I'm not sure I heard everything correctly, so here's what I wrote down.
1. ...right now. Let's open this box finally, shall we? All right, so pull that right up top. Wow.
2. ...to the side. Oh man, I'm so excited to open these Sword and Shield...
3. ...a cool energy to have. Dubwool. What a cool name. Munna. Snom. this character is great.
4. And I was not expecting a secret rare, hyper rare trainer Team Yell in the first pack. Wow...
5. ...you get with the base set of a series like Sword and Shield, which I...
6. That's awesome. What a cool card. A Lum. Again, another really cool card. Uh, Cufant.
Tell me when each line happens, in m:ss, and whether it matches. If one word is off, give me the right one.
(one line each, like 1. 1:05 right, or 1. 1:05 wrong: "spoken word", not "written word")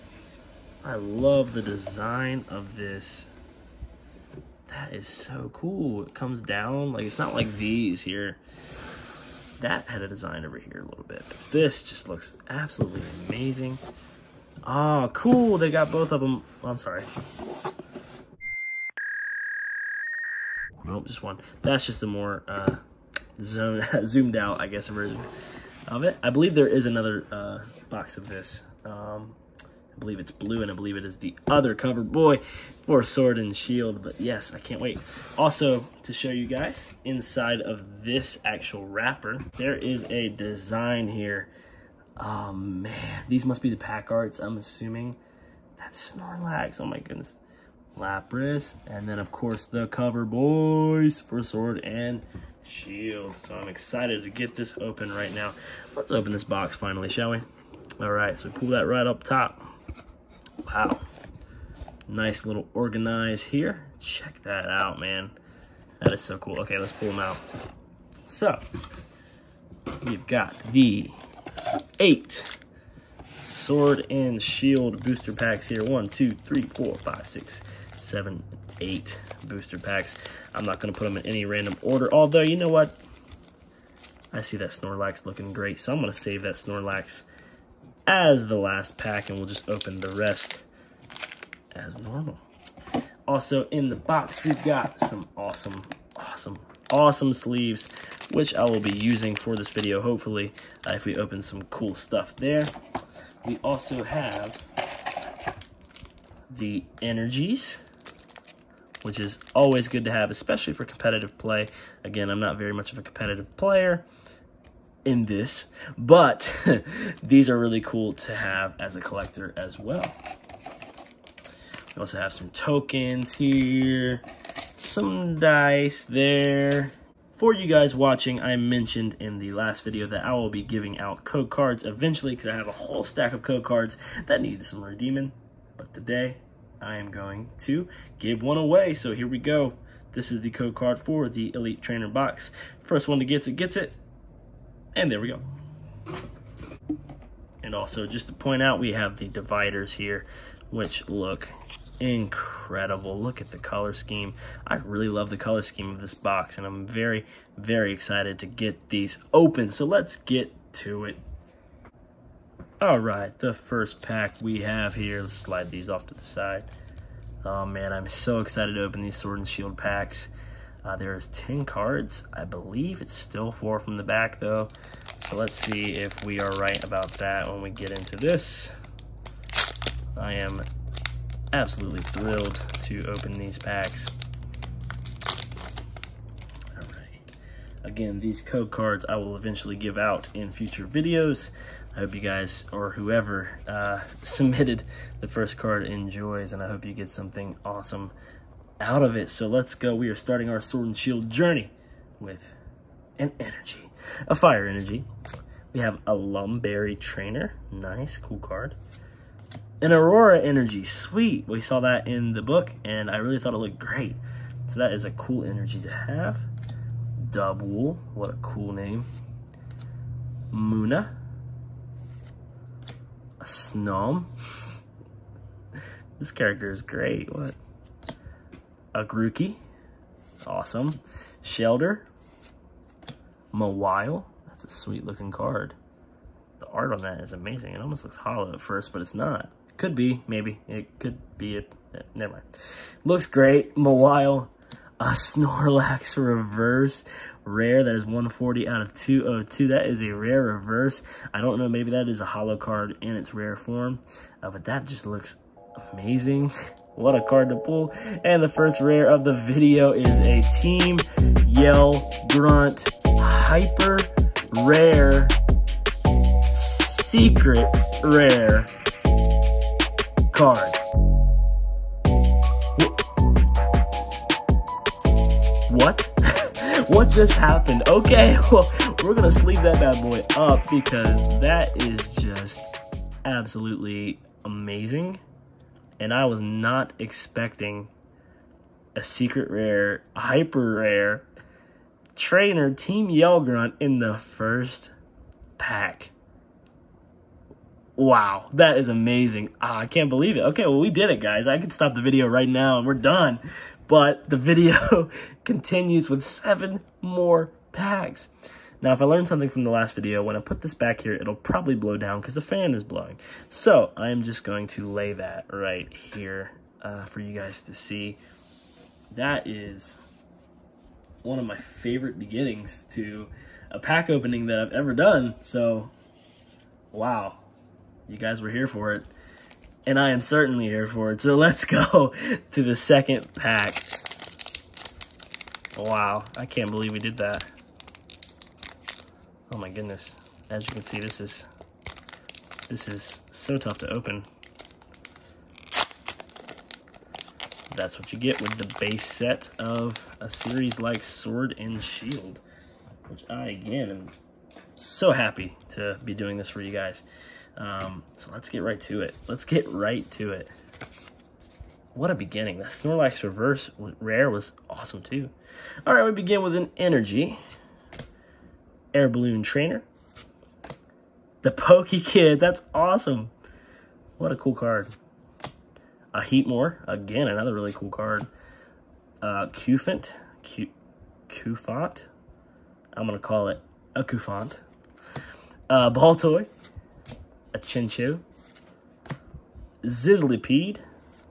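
1. 0:55 right
2. 2:46 right
3. 3:35 right
4. 4:45 right
5. 5:48 right
6. 6:12 wrong: "Heatmor", not "Lum".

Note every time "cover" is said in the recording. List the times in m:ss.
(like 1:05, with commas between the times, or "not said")
0:31, 0:49.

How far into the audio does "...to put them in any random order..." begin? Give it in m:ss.
1:20.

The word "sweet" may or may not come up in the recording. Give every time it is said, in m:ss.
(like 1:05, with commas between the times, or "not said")
3:30, 3:54.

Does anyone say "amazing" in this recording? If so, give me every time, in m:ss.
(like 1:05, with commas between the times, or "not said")
0:13, 3:57, 4:15, 4:44, 4:58.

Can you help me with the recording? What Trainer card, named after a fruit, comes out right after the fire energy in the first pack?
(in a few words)
Lum Berry.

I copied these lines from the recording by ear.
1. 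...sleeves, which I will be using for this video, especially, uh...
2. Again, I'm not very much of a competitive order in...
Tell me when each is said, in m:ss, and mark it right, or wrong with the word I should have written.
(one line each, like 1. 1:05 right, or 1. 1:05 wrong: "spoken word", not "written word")
1. 1:37 wrong: "hopefully", not "especially"
2. 1:52 wrong: "player", not "order".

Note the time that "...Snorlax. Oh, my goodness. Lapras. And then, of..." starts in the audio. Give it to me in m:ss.
0:46.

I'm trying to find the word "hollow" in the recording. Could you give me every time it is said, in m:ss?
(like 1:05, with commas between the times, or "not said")
3:58, 4:12.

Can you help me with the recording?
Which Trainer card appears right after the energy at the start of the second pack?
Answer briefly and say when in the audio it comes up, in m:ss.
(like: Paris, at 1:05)
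Air Balloon, at 6:08.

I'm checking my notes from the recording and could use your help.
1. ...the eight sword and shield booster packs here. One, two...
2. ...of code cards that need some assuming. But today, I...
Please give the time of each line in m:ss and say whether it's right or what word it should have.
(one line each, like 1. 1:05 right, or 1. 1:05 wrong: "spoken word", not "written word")
1. 1:10 right
2. 2:13 wrong: "redeeming", not "assuming".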